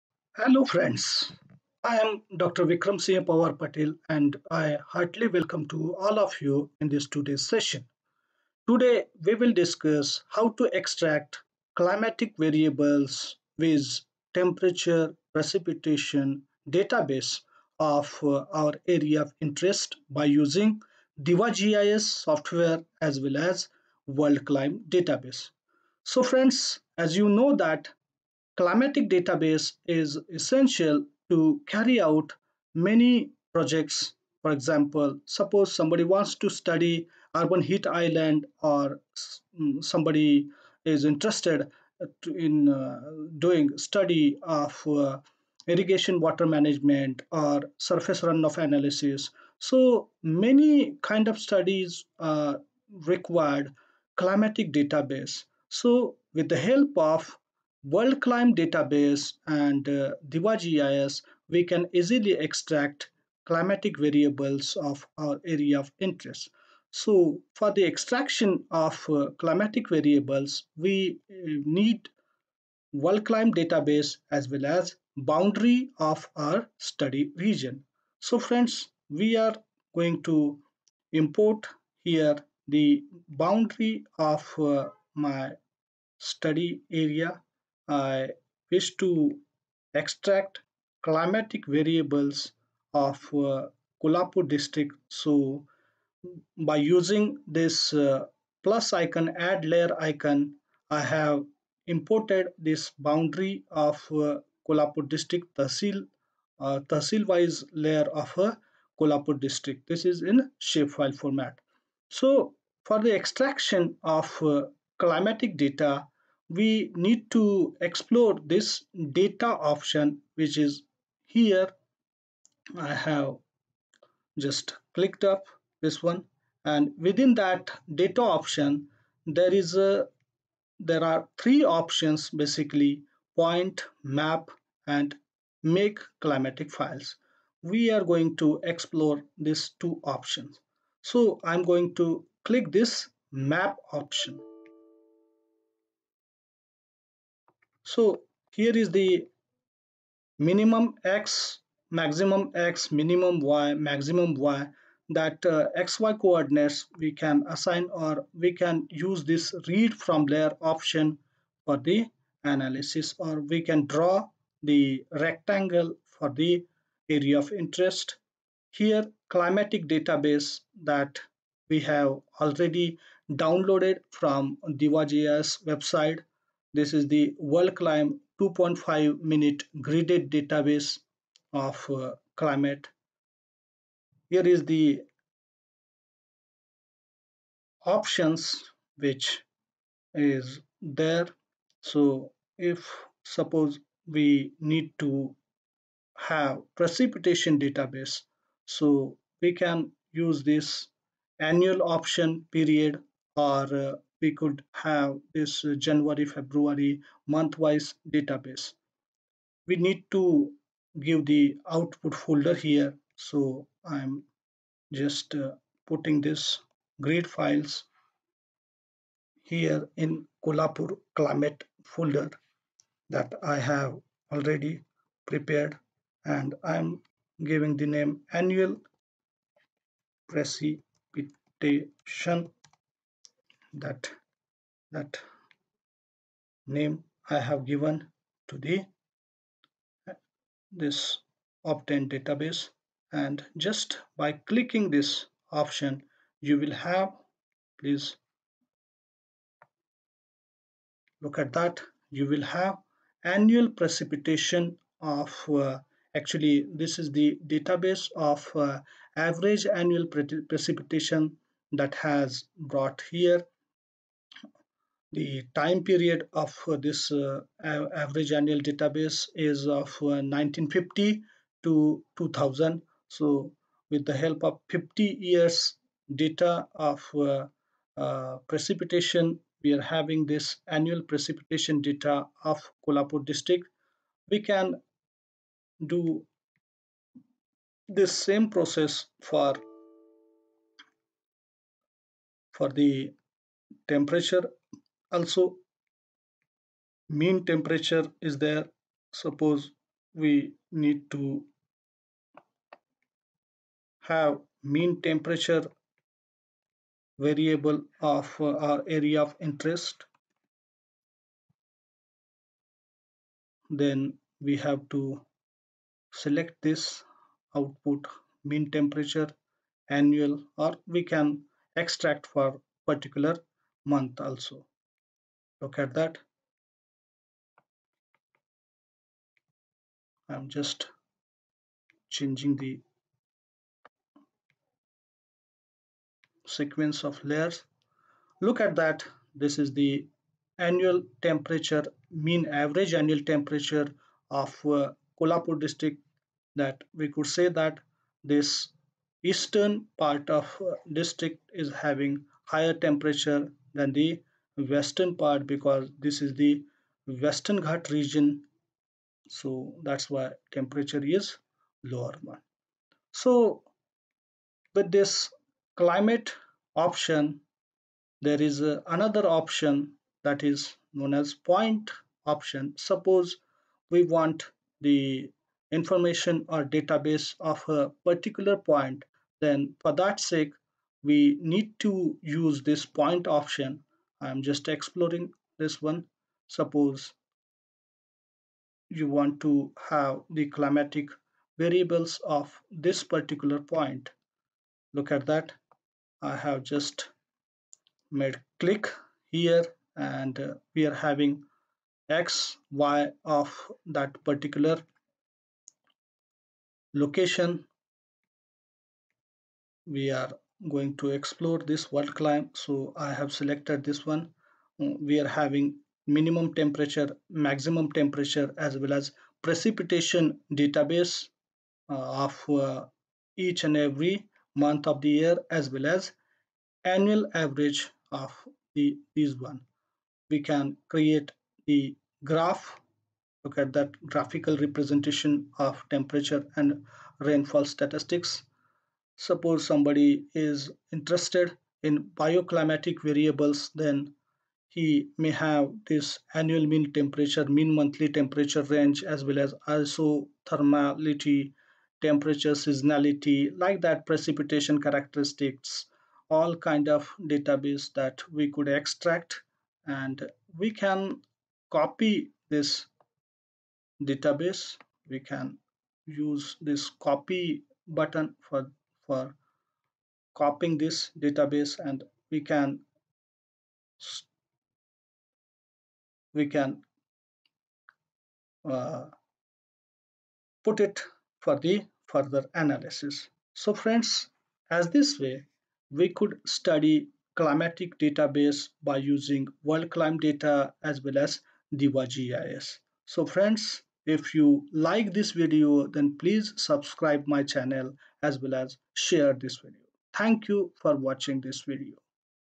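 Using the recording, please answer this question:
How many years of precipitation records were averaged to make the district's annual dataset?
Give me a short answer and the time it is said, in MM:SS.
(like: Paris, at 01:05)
50, at 04:34.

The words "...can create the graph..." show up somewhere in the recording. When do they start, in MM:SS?
07:10.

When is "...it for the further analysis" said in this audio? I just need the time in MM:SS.
08:00.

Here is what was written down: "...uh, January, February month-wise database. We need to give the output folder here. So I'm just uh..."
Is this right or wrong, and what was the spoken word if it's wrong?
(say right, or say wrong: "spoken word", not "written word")
right.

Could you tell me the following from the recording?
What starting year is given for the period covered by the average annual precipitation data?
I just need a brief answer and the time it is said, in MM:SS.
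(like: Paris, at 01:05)
1950, at 04:29.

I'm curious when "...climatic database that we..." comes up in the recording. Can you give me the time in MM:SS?
02:49.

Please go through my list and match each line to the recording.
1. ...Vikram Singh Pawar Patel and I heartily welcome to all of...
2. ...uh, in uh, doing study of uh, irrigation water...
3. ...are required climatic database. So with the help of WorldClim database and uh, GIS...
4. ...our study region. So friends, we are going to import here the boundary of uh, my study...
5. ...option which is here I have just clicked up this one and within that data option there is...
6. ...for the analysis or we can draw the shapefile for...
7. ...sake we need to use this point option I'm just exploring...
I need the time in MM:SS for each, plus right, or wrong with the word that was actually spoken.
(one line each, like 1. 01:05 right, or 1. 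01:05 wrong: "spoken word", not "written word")
1. 00:02 right
2. 00:42 right
3. 00:52 right
4. 01:16 right
5. 01:59 right
6. 02:41 wrong: "rectangle", not "shapefile"
7. 06:20 right.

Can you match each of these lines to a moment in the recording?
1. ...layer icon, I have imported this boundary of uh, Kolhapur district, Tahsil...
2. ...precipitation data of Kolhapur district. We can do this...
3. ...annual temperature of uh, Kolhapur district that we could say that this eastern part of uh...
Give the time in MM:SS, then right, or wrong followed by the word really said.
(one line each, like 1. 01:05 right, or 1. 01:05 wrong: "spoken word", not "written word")
1. 01:39 right
2. 04:41 right
3. 05:43 right.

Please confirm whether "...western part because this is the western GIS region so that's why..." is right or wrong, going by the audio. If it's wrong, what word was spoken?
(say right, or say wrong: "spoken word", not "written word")
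wrong: "Ghat", not "GIS".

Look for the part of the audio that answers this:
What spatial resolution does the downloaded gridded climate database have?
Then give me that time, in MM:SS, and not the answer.
02:58.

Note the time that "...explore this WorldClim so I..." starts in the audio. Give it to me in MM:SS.
06:51.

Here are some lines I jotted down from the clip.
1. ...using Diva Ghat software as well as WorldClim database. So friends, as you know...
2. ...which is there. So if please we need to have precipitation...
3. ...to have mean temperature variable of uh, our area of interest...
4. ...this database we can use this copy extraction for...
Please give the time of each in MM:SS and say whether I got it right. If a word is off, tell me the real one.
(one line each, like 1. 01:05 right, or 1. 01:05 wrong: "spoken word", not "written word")
1. 00:20 wrong: "GIS", not "Ghat"
2. 03:08 wrong: "suppose", not "please"
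3. 05:01 right
4. 07:42 wrong: "button", not "extraction".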